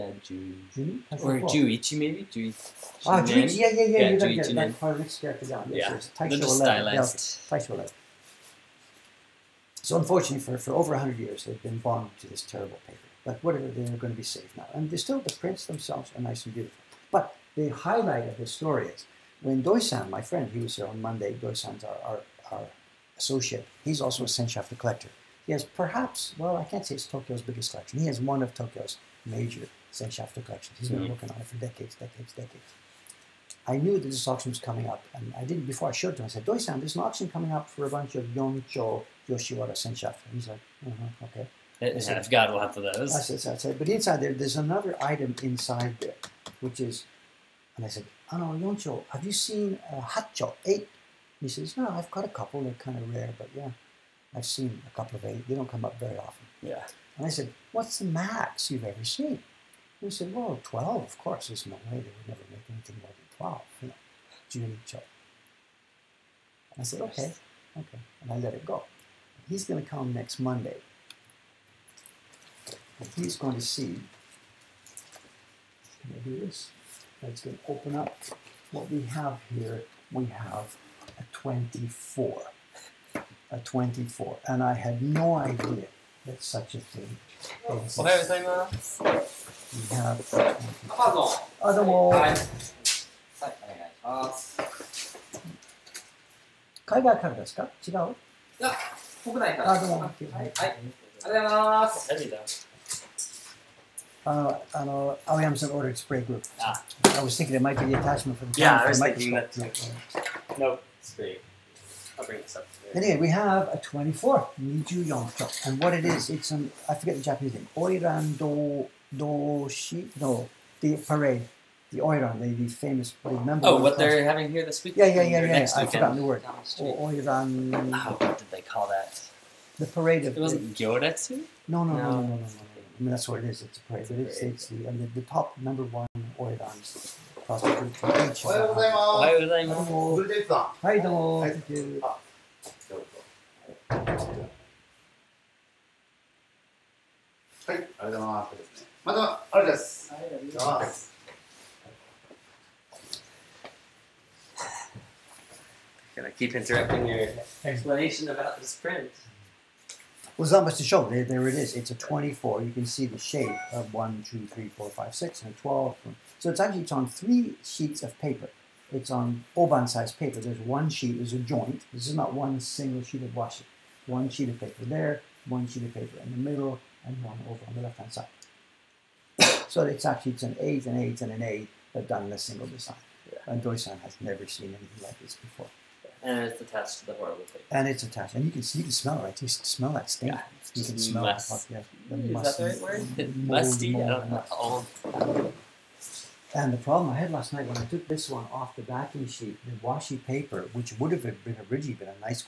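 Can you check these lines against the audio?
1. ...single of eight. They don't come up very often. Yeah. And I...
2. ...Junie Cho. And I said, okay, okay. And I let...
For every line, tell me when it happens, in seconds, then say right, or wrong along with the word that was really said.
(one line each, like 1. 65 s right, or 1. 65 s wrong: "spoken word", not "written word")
1. 54 s wrong: "couple", not "single"
2. 64 s right.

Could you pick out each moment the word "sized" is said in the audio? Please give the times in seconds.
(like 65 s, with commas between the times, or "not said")
169 s.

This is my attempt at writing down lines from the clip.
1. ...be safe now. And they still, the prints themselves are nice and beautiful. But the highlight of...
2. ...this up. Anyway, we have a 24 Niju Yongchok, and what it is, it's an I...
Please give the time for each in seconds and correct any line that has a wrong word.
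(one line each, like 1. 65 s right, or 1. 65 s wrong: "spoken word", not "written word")
1. 14 s right
2. 112 s right.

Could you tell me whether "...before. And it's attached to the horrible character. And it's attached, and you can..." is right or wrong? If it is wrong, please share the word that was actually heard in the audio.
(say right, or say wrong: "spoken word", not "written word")
wrong: "paper", not "character".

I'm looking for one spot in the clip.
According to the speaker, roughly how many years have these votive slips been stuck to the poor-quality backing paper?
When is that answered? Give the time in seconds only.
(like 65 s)
10 s.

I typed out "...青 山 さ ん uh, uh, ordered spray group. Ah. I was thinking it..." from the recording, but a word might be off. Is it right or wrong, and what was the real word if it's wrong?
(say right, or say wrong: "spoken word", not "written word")
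right.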